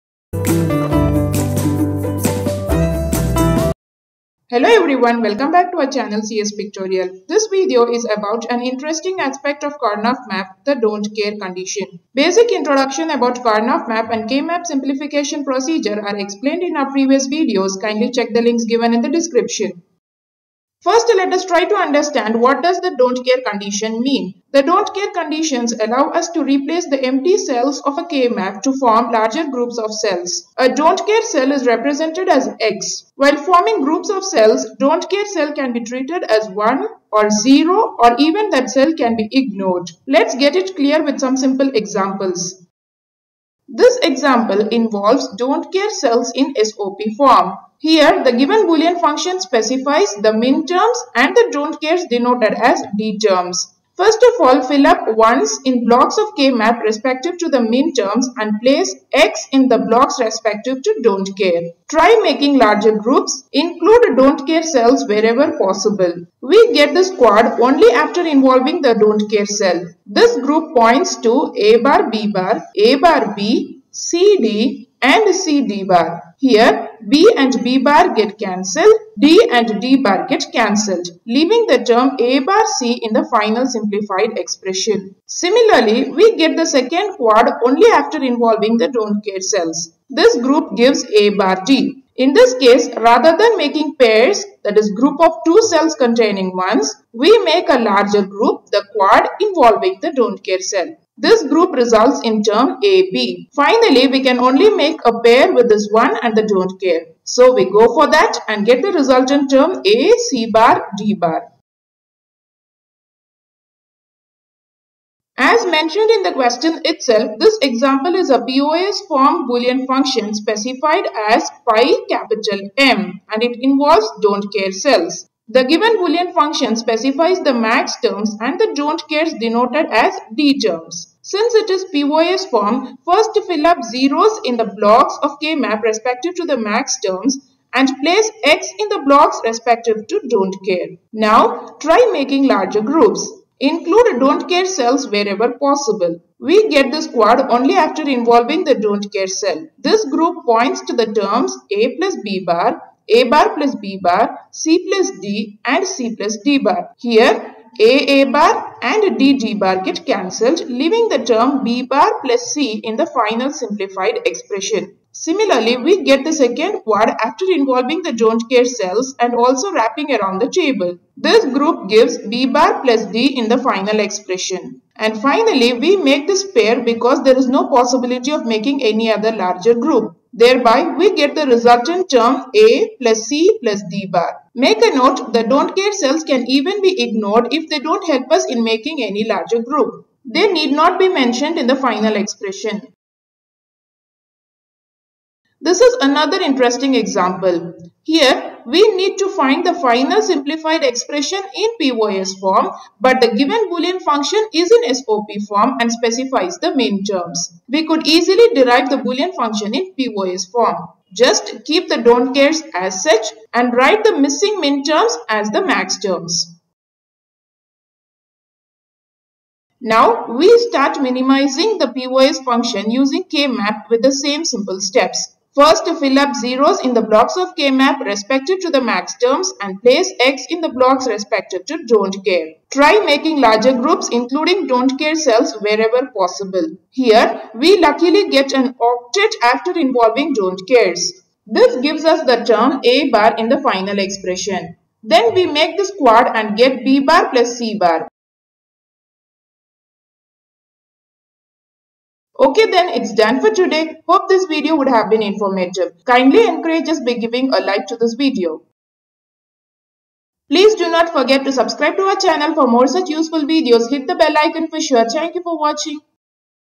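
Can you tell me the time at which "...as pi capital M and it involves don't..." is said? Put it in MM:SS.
02:01.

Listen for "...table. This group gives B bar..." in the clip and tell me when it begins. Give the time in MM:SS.
02:50.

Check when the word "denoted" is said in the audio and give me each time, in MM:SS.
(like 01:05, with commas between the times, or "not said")
00:52, 02:09.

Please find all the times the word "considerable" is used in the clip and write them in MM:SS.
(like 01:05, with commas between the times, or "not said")
not said.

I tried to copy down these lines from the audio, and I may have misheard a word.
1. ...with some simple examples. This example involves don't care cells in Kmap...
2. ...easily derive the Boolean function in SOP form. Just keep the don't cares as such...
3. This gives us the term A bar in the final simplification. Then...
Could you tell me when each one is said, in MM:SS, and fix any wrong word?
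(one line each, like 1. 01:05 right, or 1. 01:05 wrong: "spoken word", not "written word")
1. 00:41 wrong: "SOP", not "Kmap"
2. 03:28 wrong: "POS", not "SOP"
3. 04:01 wrong: "expression", not "simplification".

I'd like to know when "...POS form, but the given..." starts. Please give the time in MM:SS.
03:21.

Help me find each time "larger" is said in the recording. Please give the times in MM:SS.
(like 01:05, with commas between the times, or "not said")
00:29, 01:02, 01:37, 02:22, 02:59, 03:09, 03:53.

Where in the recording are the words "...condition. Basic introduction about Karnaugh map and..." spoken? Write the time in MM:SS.
00:11.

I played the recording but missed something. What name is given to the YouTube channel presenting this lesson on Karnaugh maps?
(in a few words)
CS Pictorial.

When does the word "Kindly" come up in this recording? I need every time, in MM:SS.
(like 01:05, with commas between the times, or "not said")
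00:17, 04:16.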